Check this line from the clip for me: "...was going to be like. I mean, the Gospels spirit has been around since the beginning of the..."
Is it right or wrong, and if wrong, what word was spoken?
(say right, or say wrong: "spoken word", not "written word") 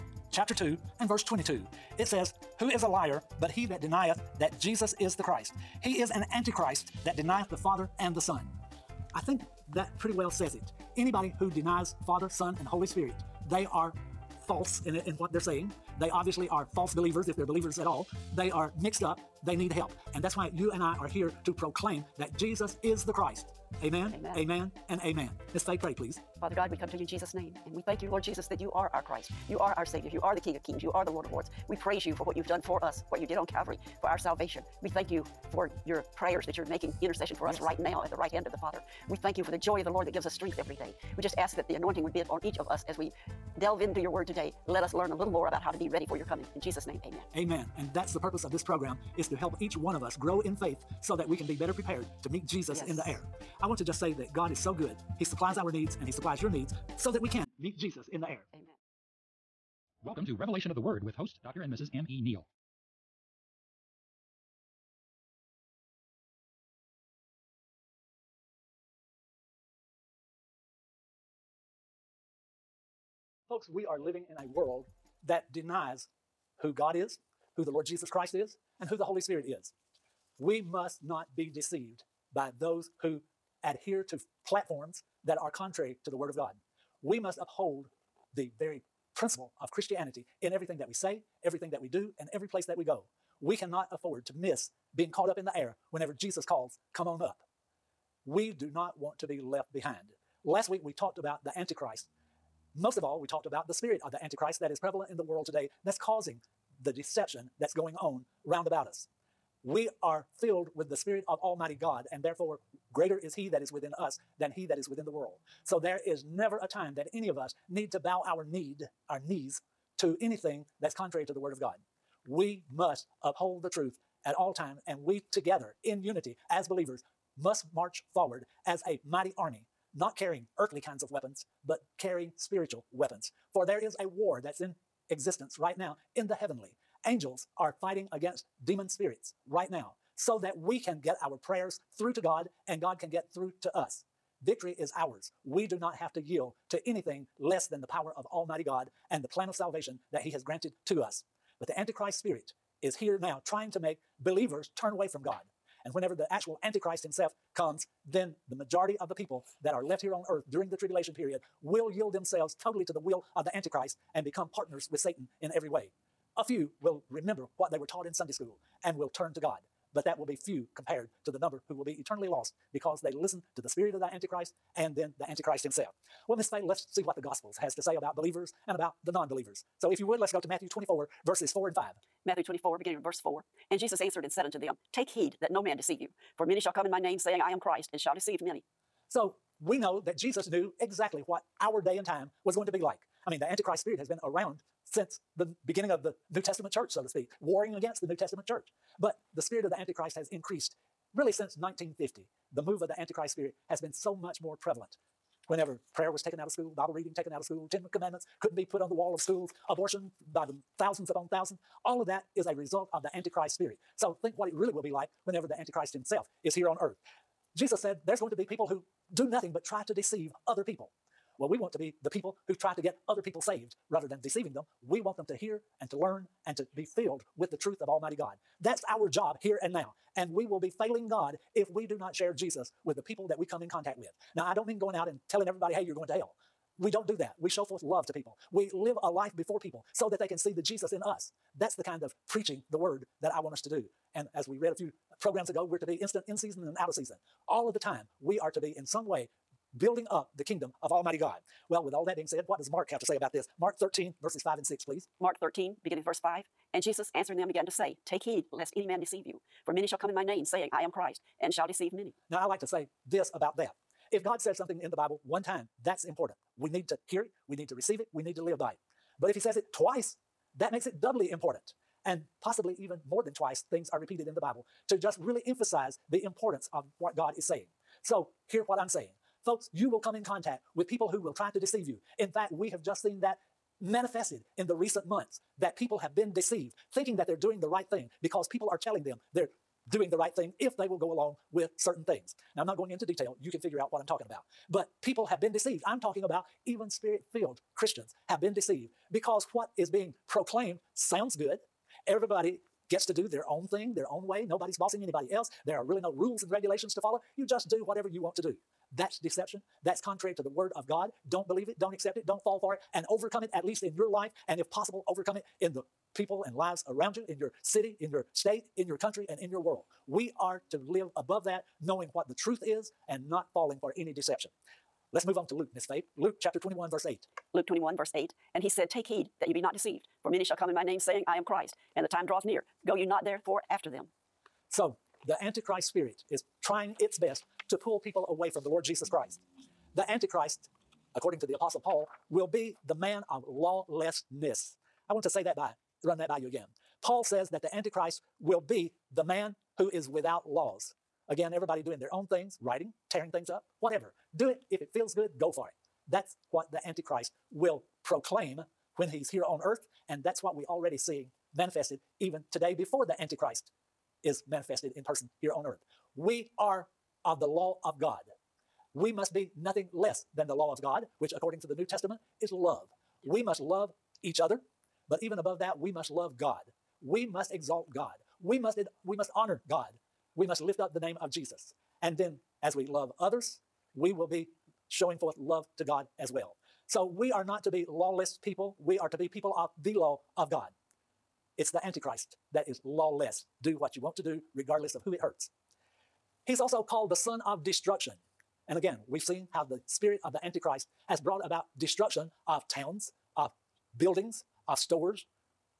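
wrong: "Antichrist", not "Gospels".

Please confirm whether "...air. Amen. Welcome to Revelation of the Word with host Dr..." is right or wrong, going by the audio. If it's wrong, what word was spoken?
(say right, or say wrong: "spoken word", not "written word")
right.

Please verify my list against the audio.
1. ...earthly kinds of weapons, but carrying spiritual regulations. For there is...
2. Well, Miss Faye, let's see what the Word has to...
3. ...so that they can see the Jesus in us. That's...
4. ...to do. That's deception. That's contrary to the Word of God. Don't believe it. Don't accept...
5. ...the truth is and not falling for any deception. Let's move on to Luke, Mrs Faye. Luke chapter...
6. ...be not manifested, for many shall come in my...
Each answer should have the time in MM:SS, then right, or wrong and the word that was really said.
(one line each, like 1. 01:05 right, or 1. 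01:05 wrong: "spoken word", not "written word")
1. 02:10 wrong: "weapons", not "regulations"
2. 02:56 wrong: "Gospels", not "Word"
3. 03:59 right
4. 05:08 right
5. 05:22 wrong: "Miss", not "Mrs"
6. 05:29 wrong: "deceived", not "manifested".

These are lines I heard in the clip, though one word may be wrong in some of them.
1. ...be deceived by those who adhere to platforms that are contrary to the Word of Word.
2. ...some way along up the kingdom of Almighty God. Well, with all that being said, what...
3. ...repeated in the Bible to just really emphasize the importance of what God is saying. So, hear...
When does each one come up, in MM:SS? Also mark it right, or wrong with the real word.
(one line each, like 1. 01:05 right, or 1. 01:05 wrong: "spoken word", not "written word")
1. 01:21 wrong: "God", not "Word"
2. 04:08 wrong: "building", not "along"
3. 04:33 right.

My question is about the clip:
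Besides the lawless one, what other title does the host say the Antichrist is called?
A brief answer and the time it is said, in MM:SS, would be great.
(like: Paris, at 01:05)
Son of destruction, at 06:37.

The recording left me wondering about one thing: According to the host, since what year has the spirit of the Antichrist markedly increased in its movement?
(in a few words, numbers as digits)
1950.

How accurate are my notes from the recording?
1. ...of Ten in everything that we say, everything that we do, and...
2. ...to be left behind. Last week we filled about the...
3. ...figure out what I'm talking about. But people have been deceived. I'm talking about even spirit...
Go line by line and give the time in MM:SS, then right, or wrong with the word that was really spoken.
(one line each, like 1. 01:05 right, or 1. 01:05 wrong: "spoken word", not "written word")
1. 01:29 wrong: "Christianity", not "Ten"
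2. 01:39 wrong: "talked", not "filled"
3. 04:53 right.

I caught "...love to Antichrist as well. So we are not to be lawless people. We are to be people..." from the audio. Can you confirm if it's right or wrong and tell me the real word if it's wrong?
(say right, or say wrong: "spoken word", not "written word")
wrong: "God", not "Antichrist".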